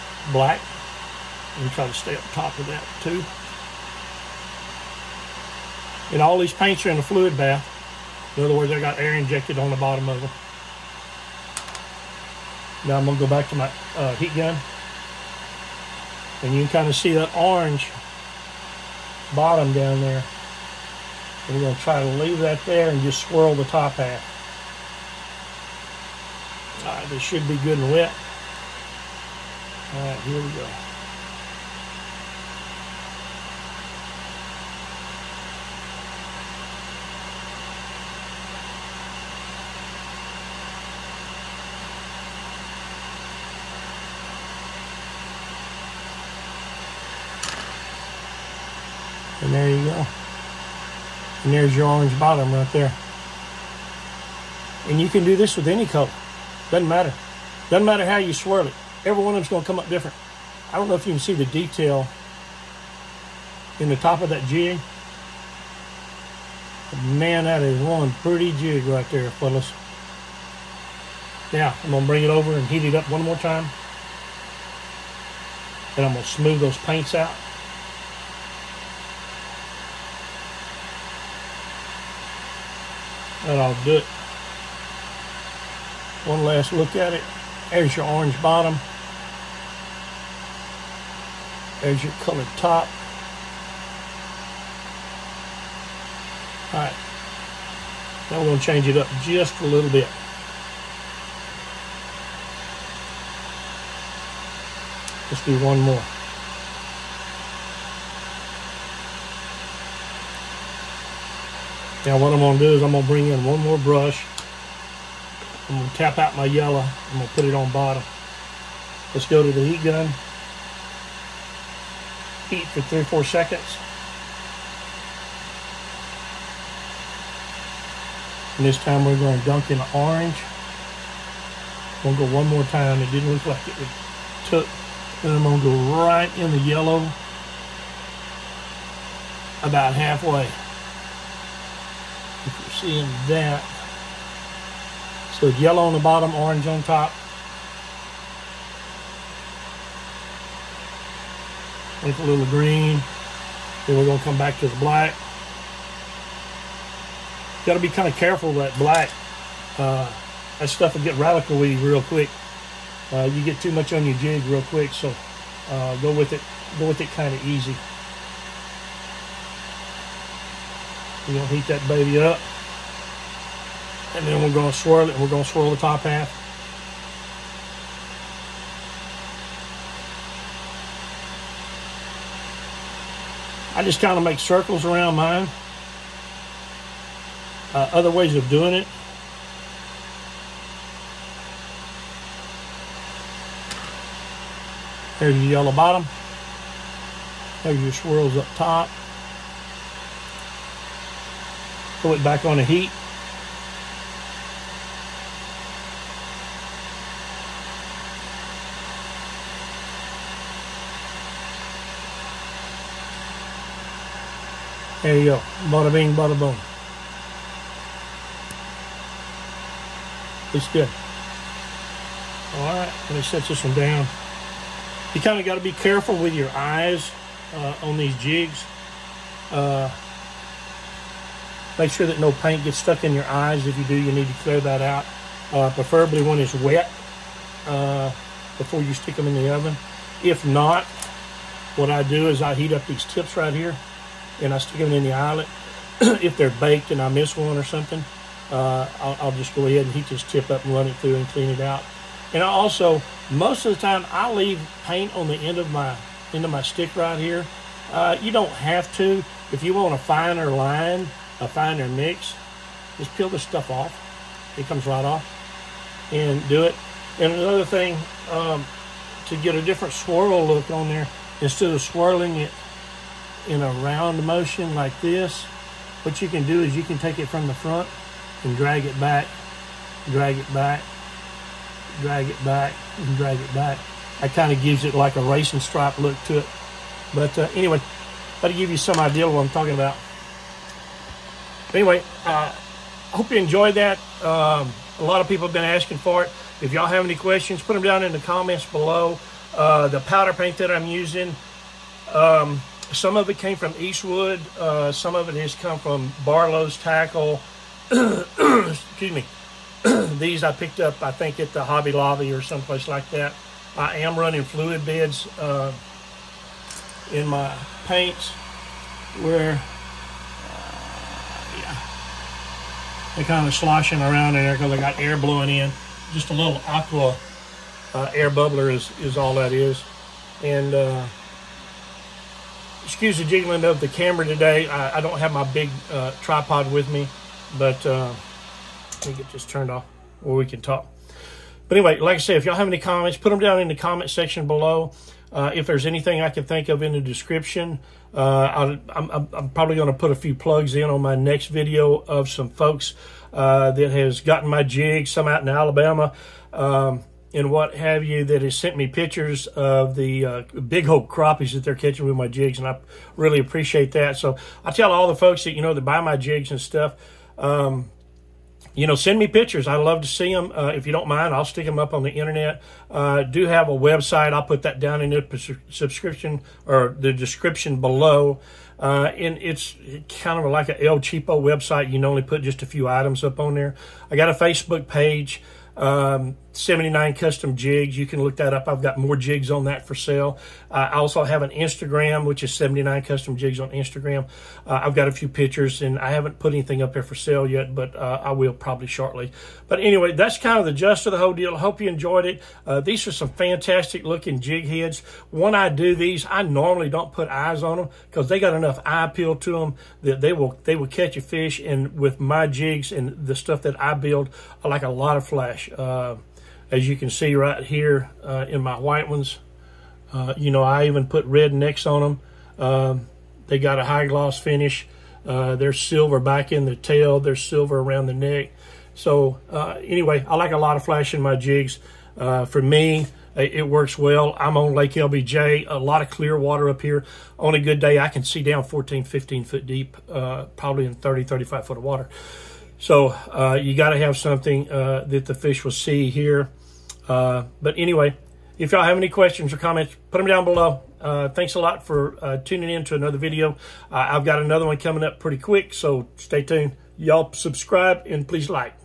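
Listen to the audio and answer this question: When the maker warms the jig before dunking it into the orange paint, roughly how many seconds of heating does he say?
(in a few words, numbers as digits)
3 or 4 seconds.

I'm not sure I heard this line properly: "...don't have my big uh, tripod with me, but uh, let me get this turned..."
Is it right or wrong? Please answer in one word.
right.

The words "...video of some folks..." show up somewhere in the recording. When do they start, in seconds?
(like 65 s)
351 s.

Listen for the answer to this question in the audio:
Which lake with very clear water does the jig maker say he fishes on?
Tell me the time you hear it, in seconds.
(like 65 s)
434 s.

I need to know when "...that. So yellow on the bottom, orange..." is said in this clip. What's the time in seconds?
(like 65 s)
143 s.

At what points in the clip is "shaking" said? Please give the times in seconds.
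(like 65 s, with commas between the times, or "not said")
not said.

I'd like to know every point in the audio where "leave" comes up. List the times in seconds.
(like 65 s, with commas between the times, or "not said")
22 s, 254 s.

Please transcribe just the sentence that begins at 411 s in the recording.
And with my jigs and the stuff that I build, I like a lot of flash.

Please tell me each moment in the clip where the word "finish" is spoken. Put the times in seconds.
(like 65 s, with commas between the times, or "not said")
424 s.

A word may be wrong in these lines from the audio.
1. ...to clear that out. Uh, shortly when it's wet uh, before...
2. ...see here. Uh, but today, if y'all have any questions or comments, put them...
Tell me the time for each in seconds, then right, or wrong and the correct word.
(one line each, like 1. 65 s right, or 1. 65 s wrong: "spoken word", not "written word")
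1. 234 s wrong: "preferably", not "shortly"
2. 445 s wrong: "anyway", not "today".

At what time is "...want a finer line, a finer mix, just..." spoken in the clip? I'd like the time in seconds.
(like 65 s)
259 s.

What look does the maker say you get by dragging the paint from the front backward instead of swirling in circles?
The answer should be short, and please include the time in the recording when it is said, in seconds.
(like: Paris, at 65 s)
Racing stripe, at 285 s.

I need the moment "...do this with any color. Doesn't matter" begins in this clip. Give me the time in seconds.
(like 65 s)
55 s.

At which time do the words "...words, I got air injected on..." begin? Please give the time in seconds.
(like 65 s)
8 s.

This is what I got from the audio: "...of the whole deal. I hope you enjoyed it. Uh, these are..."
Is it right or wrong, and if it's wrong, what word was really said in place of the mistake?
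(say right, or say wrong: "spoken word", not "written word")
right.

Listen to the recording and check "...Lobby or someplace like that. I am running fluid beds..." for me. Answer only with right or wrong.
right.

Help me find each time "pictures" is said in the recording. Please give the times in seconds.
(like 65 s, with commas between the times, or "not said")
358 s, 369 s, 395 s.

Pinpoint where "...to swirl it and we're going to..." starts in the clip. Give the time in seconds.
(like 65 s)
174 s.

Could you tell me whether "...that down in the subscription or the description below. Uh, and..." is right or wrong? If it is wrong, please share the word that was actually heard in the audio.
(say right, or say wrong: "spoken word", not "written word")
right.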